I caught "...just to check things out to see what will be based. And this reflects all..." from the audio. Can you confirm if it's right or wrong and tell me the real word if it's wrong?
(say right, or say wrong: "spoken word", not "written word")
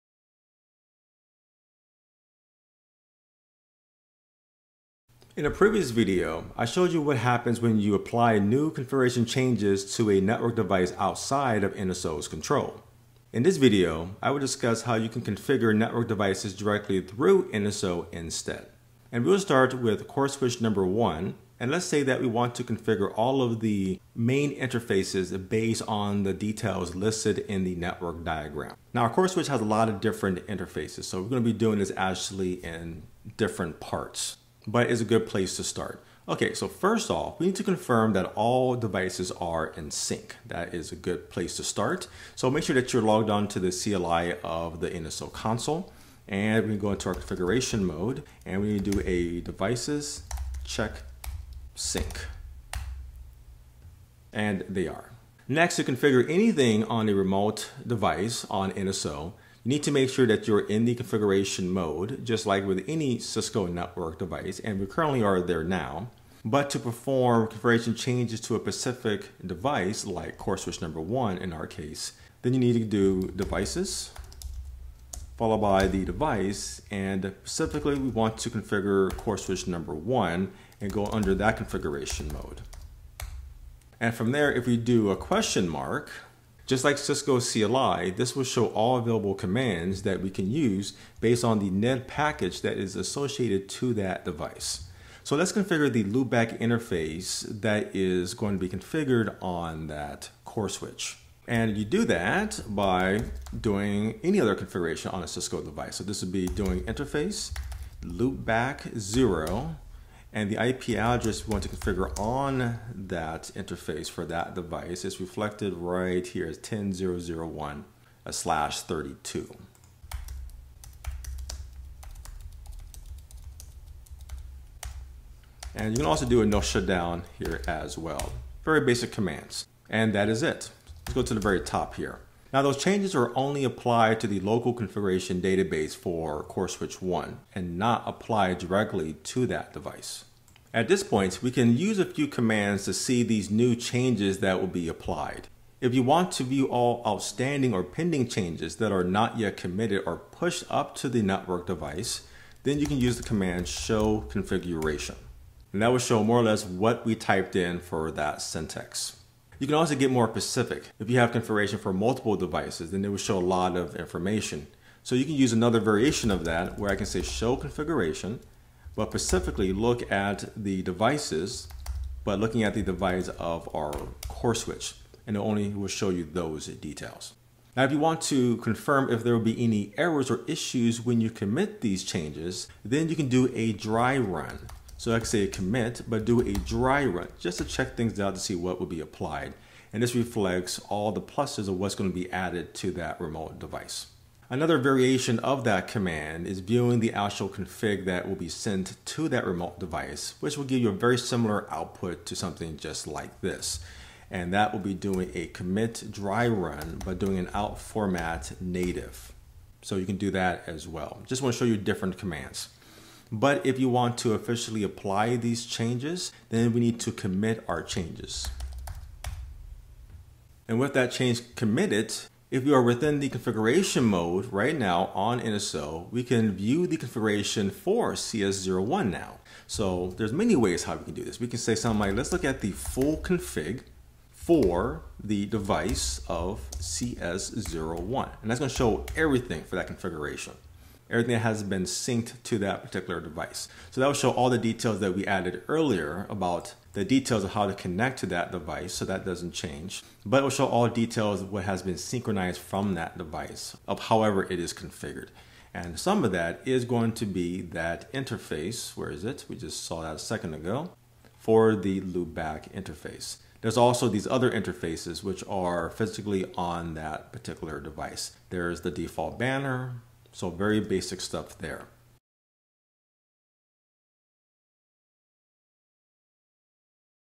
wrong: "applied", not "based".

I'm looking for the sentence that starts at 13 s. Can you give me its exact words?
In this video, I will discuss how you can configure network devices directly through NSO instead.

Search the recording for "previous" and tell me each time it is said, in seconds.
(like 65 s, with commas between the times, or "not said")
5 s.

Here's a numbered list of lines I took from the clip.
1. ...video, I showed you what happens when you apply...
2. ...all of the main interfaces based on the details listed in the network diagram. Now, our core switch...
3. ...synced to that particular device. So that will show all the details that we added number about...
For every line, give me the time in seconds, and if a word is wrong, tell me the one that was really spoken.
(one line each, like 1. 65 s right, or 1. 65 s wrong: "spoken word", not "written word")
1. 5 s right
2. 23 s right
3. 241 s wrong: "earlier", not "number".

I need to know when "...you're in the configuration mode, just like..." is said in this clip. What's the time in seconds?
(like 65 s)
60 s.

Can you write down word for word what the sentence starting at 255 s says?
And some of that is going to be that interface.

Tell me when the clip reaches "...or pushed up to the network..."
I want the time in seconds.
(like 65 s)
150 s.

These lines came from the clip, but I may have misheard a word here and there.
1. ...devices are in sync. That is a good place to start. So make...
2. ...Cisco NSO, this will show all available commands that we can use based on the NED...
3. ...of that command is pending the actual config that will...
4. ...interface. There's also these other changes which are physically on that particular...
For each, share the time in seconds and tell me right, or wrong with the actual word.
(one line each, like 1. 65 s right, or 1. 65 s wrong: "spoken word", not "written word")
1. 38 s right
2. 86 s wrong: "CLI", not "NSO"
3. 195 s wrong: "viewing", not "pending"
4. 262 s wrong: "interfaces", not "changes".